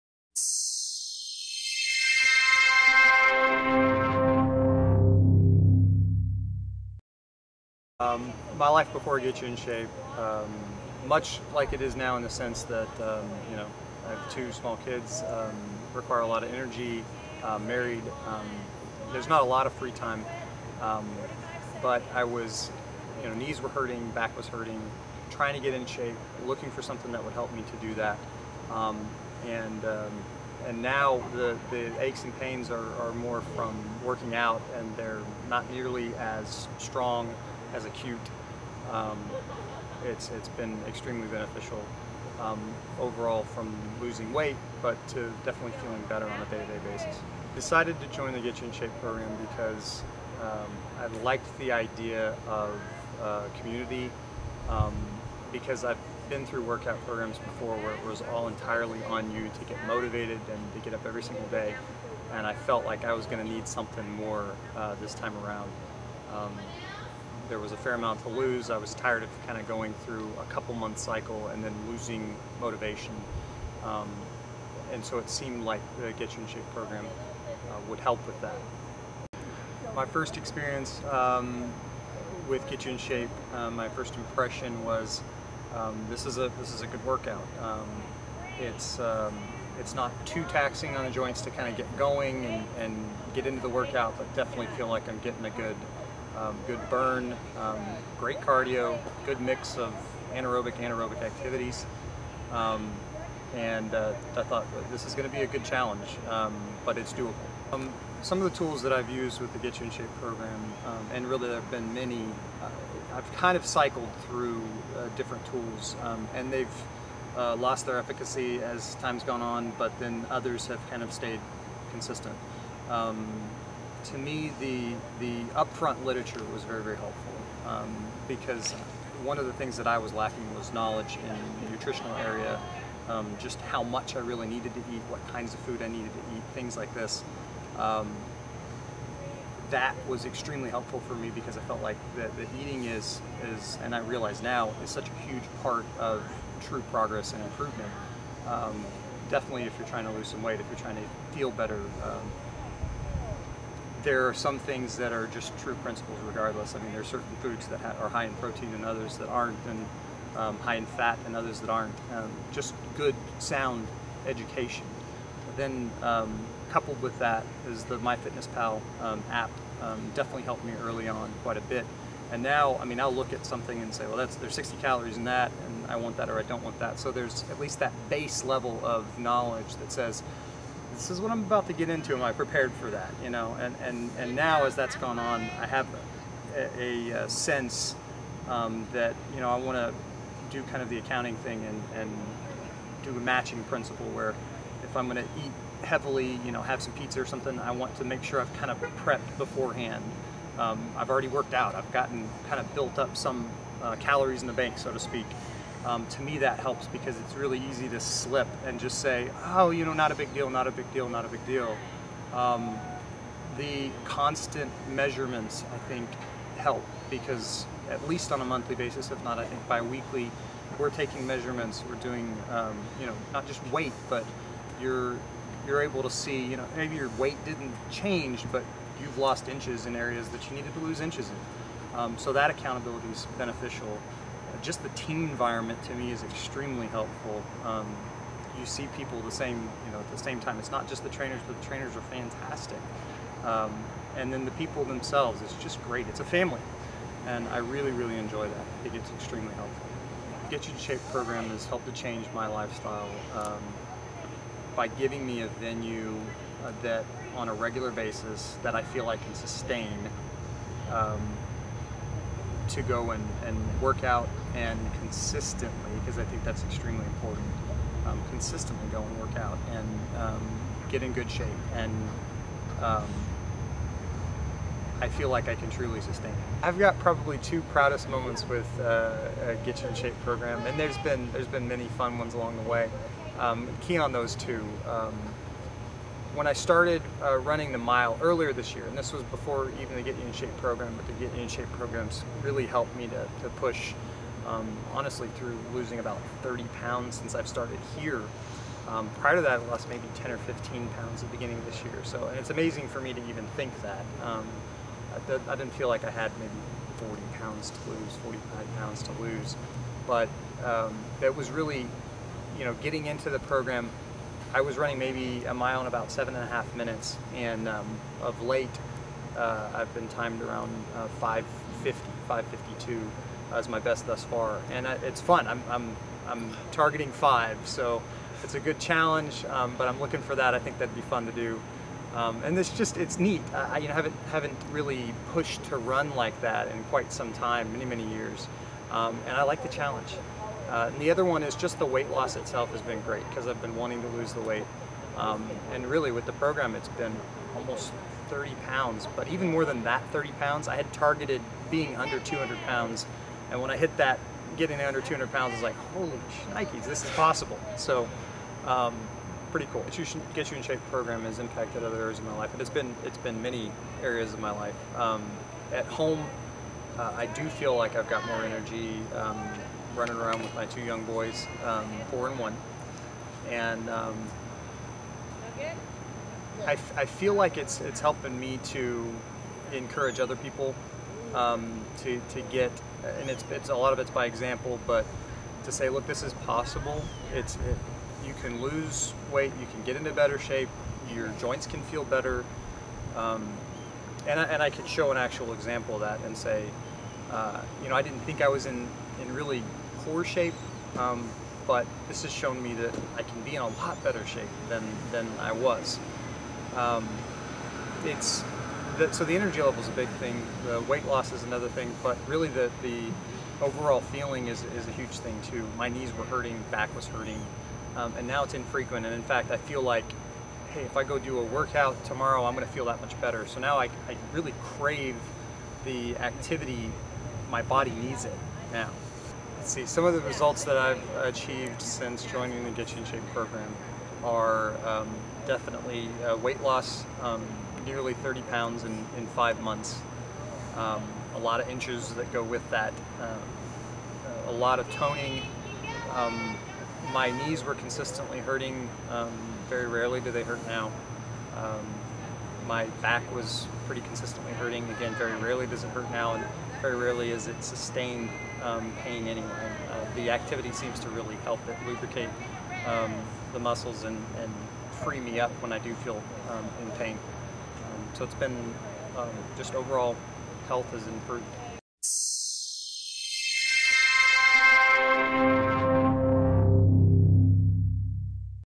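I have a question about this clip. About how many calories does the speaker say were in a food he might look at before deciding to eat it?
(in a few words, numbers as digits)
60.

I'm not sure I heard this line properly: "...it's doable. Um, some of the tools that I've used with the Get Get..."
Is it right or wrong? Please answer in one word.
wrong.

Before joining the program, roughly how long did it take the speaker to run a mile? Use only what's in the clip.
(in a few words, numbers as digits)
7.5 minutes.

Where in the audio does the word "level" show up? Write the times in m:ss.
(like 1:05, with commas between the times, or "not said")
2:58, 6:49.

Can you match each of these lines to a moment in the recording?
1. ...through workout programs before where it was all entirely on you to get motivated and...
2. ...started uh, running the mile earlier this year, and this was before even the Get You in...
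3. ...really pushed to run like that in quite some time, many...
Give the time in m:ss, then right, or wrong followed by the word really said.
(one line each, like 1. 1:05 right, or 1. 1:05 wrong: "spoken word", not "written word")
1. 0:56 right
2. 4:46 right
3. 5:34 right.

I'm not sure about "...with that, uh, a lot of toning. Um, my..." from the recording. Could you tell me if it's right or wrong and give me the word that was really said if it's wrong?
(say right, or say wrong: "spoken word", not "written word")
right.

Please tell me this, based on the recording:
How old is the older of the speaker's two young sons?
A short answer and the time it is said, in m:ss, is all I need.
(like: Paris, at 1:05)
4, at 6:12.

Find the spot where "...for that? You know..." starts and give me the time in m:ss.
3:02.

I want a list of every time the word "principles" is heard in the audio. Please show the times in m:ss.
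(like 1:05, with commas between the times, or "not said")
2:35, 3:13.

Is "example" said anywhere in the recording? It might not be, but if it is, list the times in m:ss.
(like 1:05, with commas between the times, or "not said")
6:24, 6:35.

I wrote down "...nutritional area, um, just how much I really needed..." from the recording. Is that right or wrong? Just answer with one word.
right.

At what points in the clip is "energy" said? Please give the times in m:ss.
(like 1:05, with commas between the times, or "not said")
0:16, 6:08, 6:49.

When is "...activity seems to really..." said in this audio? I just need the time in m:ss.
7:40.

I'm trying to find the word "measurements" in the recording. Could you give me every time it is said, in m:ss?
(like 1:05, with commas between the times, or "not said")
3:34, 3:41.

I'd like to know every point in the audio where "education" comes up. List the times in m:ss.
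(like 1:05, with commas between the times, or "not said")
2:44.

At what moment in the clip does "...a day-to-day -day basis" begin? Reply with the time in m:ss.
0:46.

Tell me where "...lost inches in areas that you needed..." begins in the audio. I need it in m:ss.
3:49.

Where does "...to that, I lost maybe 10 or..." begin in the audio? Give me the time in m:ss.
4:59.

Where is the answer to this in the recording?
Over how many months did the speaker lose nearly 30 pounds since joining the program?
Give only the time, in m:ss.
7:19.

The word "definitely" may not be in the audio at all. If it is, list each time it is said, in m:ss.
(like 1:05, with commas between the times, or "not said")
0:45, 1:34, 2:29, 2:50, 7:15.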